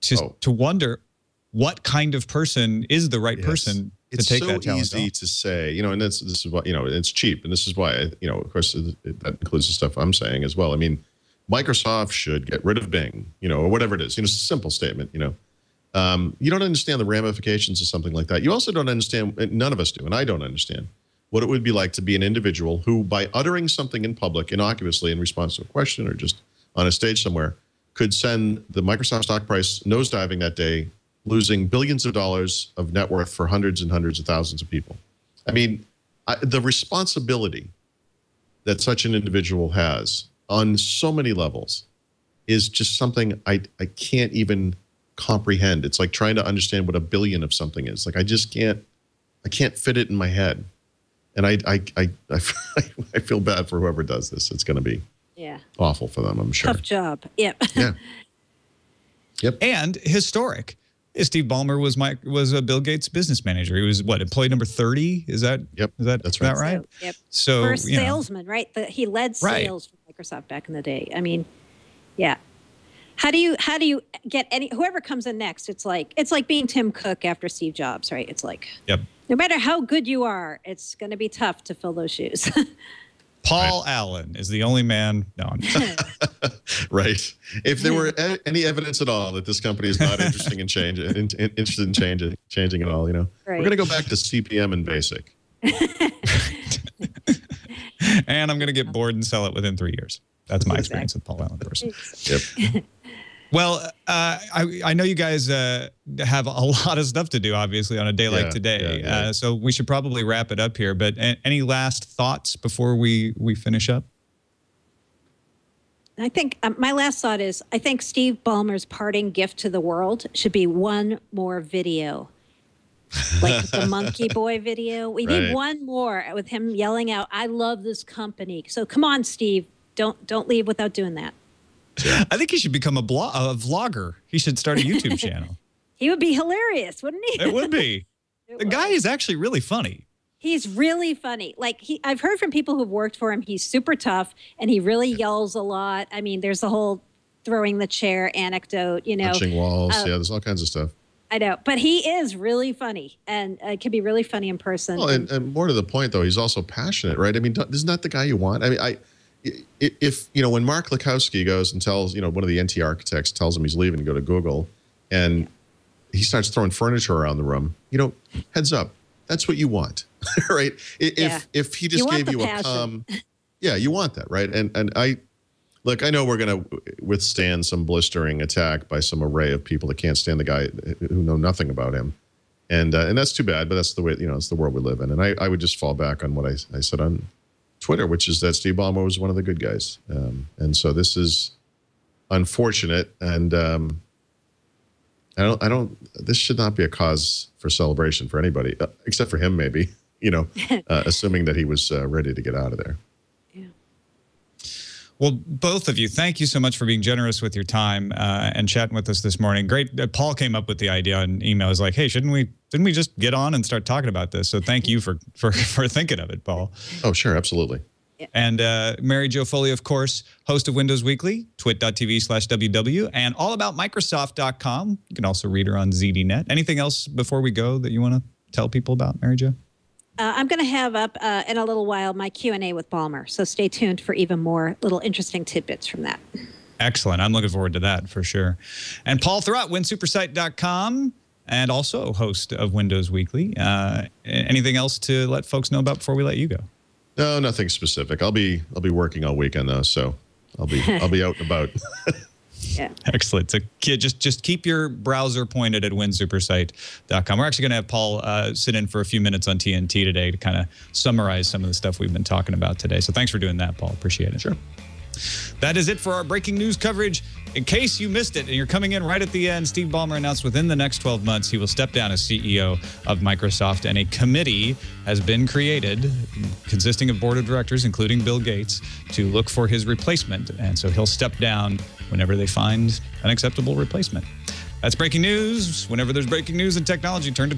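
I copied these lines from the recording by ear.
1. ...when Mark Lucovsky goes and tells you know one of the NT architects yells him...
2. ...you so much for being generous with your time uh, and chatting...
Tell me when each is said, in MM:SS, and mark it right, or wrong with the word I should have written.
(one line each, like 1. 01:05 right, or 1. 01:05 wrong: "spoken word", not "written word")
1. 02:40 wrong: "tells", not "yells"
2. 03:26 right.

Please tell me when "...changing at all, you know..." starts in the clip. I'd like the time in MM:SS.
01:32.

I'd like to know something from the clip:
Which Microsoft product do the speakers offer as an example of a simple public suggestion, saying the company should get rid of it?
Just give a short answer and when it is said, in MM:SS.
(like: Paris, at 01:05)
Bing, at 00:12.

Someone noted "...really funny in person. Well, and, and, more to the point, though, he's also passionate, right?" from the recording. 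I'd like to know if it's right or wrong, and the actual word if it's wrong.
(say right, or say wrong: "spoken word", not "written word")
right.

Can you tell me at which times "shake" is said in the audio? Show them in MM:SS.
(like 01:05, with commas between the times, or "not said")
not said.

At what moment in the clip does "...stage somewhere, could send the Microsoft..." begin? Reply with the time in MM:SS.
00:26.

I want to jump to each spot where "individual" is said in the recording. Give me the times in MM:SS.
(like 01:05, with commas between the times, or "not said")
00:22, 00:39.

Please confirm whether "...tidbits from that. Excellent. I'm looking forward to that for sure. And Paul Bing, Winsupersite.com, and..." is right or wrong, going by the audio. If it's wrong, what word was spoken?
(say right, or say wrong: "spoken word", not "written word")
wrong: "Thurrott", not "Bing".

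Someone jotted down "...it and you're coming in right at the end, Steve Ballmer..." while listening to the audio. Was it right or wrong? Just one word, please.
right.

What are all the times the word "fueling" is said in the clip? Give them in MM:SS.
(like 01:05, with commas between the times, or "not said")
not said.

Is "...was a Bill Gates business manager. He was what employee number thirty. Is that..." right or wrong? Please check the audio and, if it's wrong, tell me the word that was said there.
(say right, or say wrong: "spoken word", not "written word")
right.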